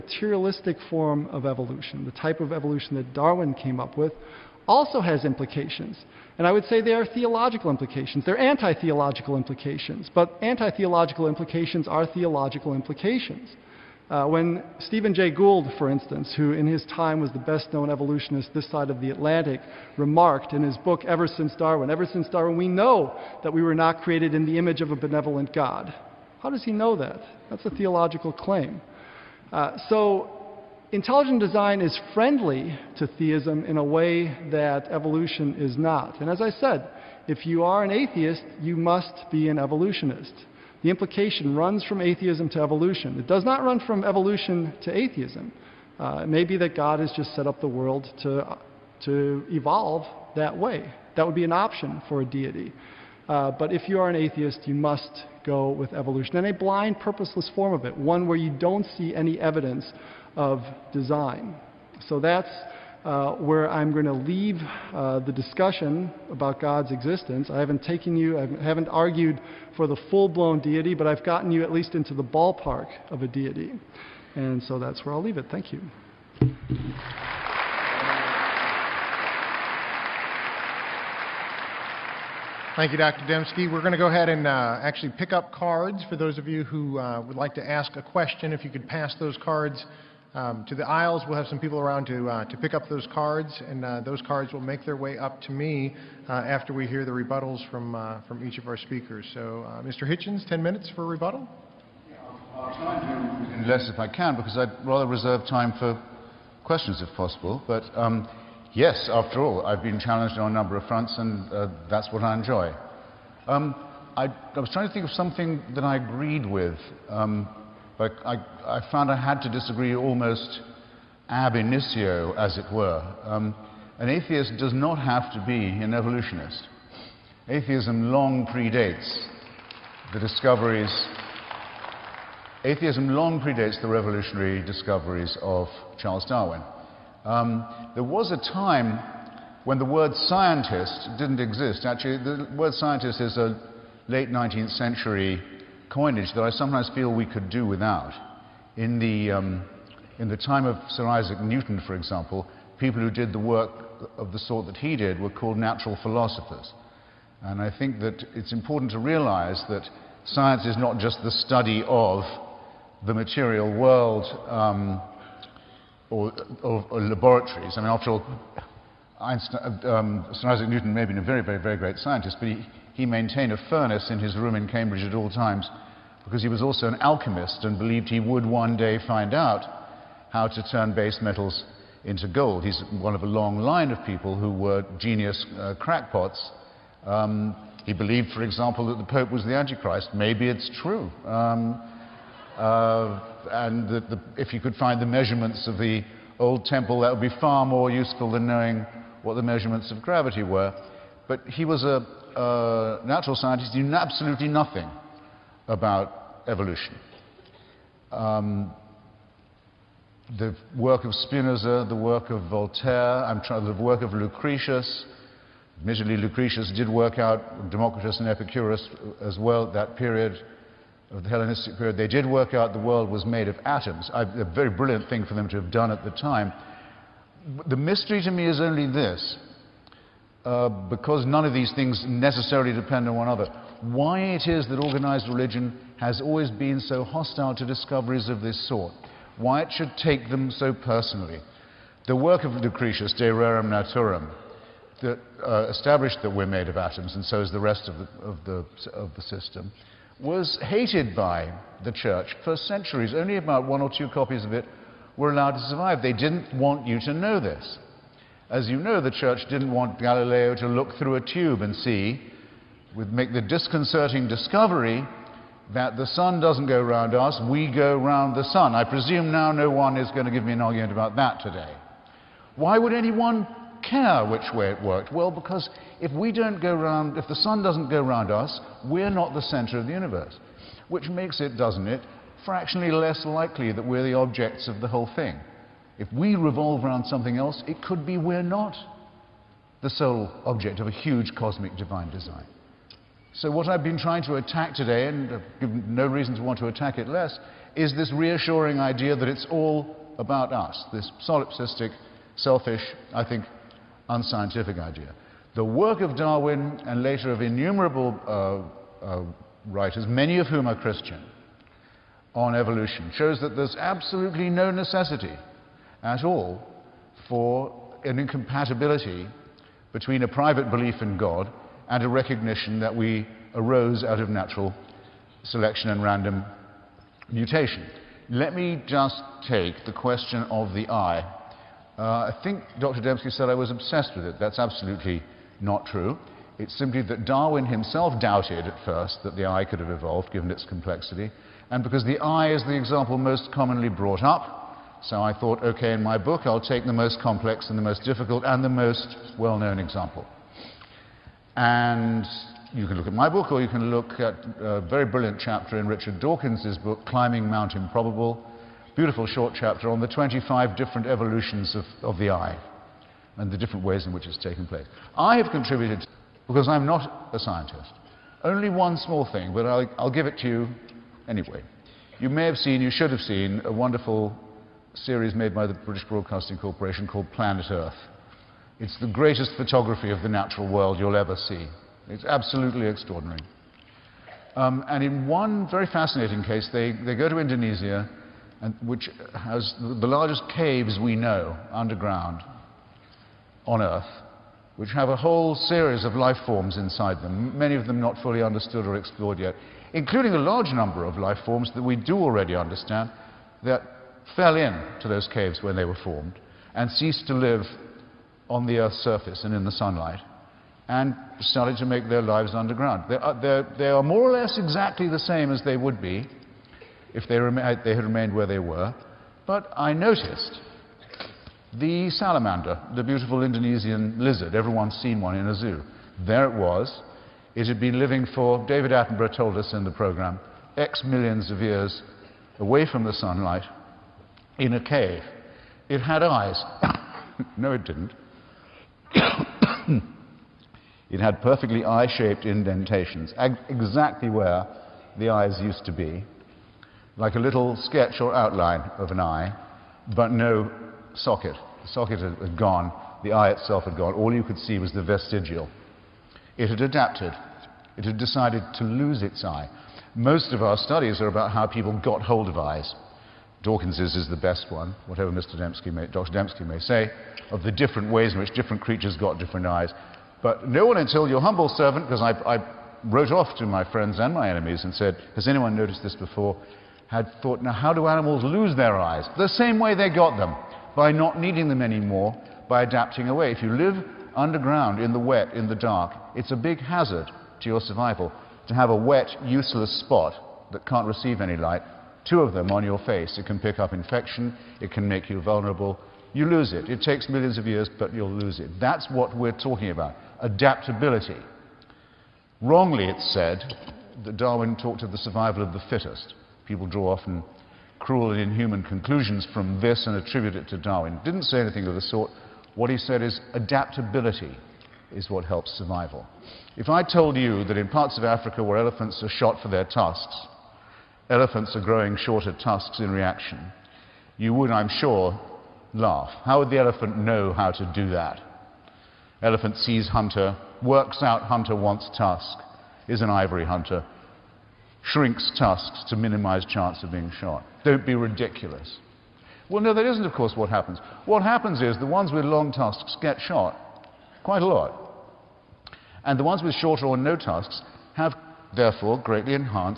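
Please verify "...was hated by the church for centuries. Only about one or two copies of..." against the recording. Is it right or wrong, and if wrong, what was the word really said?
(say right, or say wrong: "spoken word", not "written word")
right.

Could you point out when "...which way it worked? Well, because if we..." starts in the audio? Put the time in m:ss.
4:34.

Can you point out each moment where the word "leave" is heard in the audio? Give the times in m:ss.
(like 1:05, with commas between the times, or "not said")
1:04, 1:15.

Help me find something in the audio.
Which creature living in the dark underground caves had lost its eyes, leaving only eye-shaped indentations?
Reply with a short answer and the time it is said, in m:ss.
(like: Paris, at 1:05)
salamander, at 7:02.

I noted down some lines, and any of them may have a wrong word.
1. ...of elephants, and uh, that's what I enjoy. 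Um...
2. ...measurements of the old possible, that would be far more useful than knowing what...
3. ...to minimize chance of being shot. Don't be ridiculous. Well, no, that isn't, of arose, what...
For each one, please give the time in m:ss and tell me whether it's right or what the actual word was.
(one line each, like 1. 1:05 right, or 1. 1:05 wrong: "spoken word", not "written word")
1. 1:50 wrong: "fronts", not "elephants"
2. 3:15 wrong: "temple", not "possible"
3. 8:56 wrong: "course", not "arose".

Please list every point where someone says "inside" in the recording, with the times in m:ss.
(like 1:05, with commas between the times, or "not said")
6:36.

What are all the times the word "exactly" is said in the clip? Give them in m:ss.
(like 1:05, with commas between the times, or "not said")
6:54, 7:23.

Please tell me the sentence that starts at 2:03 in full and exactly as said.
Um, an atheist does not have to be an evolutionist.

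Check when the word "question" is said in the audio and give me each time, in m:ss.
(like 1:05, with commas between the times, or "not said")
1:28, 1:46, 5:29.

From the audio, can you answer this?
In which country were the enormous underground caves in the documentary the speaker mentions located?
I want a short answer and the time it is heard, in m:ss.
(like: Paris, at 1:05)
Indonesia, at 6:27.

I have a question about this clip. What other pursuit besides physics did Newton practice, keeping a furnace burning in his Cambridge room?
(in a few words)
alchemist.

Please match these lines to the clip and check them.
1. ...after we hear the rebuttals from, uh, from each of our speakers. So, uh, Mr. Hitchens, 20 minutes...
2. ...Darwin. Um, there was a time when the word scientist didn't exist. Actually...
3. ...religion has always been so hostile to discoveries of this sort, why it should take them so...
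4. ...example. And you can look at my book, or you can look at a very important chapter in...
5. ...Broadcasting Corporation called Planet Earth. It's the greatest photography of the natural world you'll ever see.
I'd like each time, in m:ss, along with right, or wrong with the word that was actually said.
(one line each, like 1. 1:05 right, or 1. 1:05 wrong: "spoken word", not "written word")
1. 1:36 wrong: "10", not "20"
2. 2:16 right
3. 3:55 right
4. 5:49 wrong: "brilliant", not "important"
5. 6:16 right.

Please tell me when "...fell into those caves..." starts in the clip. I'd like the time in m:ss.
6:44.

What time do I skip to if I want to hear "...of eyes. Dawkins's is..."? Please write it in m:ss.
7:42.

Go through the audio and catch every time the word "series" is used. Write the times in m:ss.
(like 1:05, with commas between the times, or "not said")
6:14, 6:35.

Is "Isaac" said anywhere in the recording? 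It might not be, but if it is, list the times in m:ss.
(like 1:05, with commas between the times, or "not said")
2:31, 2:50.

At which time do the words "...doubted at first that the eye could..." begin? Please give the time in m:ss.
5:38.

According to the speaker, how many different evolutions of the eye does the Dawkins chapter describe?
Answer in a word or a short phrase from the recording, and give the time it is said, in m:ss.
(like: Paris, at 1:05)
25, at 6:00.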